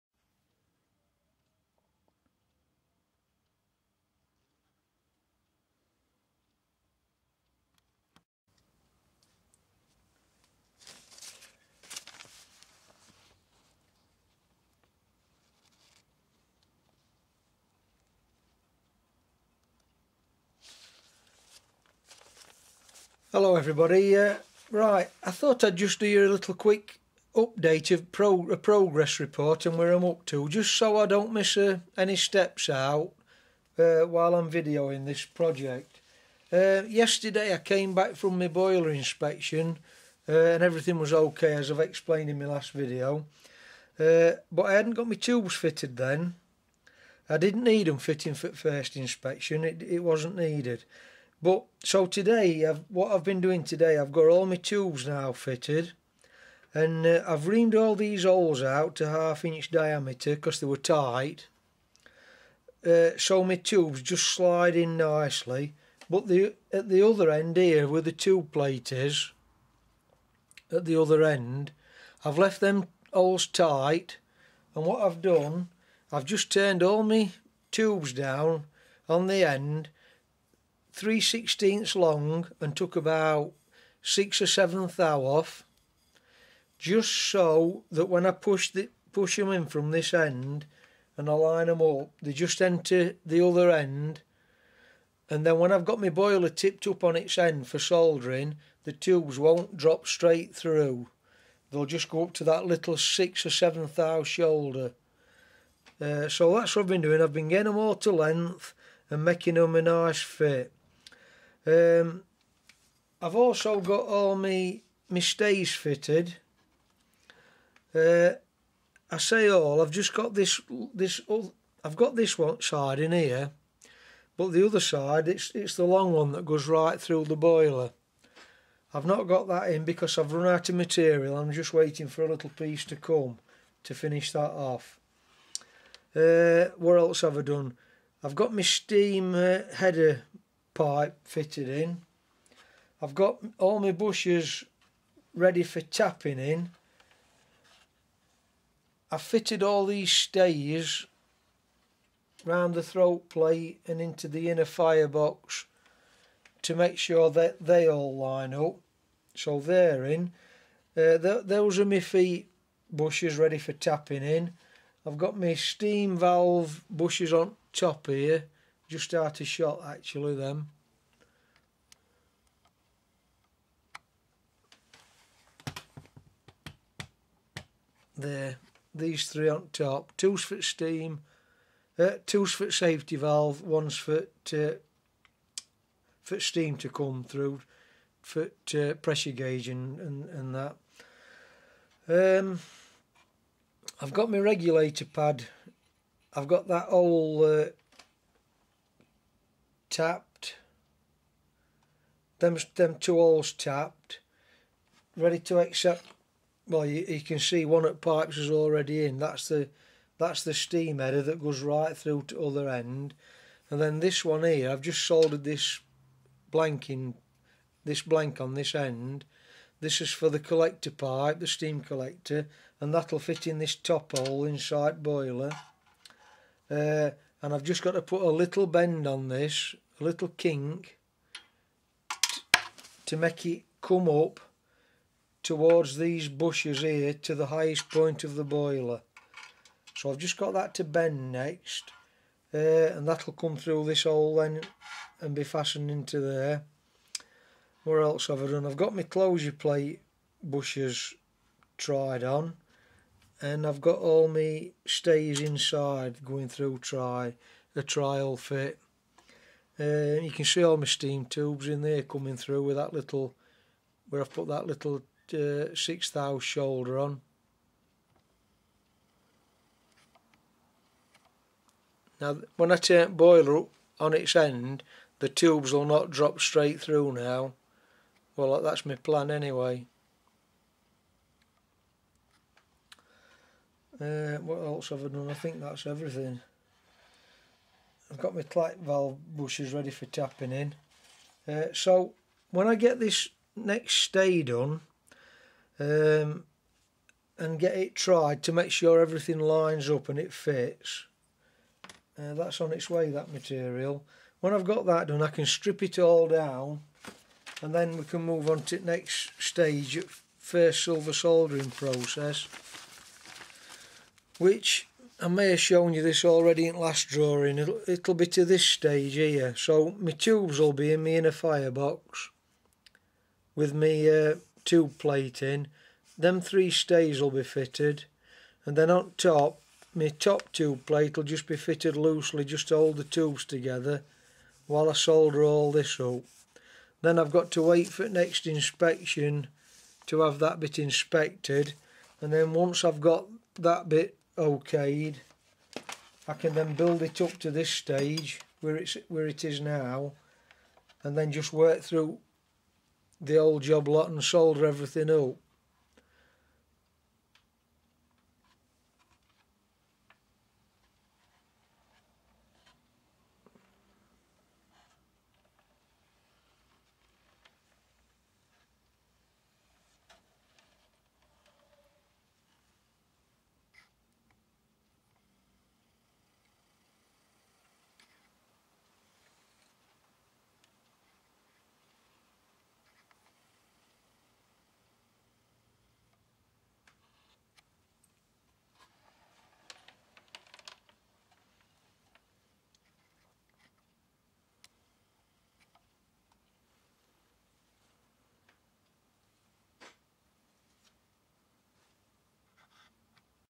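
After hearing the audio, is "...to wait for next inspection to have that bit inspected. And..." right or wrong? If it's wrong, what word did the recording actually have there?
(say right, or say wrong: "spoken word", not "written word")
right.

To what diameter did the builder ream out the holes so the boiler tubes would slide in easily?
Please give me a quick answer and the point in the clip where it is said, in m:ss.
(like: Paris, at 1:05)
1/2 inch, at 0:59.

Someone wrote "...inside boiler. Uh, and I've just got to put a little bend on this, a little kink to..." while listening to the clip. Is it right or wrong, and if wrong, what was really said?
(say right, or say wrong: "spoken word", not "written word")
right.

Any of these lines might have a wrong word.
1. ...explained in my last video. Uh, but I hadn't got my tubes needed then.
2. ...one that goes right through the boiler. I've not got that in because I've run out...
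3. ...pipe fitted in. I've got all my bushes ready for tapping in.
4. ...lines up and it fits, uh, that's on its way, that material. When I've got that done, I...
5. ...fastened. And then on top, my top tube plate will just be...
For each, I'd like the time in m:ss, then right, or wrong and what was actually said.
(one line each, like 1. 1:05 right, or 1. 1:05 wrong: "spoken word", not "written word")
1. 0:41 wrong: "fitted", not "needed"
2. 2:06 right
3. 2:20 right
4. 4:59 right
5. 5:27 wrong: "fitted", not "fastened".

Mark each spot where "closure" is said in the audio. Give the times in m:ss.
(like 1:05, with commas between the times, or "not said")
4:09.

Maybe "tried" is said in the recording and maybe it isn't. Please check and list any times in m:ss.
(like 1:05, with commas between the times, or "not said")
4:11, 4:57.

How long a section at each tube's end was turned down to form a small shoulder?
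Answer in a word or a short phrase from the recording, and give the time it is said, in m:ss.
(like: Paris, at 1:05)
3/16, at 1:20.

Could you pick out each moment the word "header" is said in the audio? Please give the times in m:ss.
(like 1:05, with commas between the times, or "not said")
2:19, 3:30.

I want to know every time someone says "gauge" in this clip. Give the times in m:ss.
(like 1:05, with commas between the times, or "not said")
3:09.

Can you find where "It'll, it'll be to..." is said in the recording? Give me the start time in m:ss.
5:17.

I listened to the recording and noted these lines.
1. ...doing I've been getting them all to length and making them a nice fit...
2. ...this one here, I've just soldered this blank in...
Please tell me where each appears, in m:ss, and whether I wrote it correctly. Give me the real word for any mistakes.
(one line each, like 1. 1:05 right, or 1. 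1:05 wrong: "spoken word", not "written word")
1. 1:47 right
2. 3:33 right.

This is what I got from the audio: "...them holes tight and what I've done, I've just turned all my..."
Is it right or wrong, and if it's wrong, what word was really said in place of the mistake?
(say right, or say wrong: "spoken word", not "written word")
right.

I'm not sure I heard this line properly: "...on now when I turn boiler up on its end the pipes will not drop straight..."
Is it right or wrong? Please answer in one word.
wrong.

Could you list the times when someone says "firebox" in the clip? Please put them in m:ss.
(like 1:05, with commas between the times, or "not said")
2:34, 5:21.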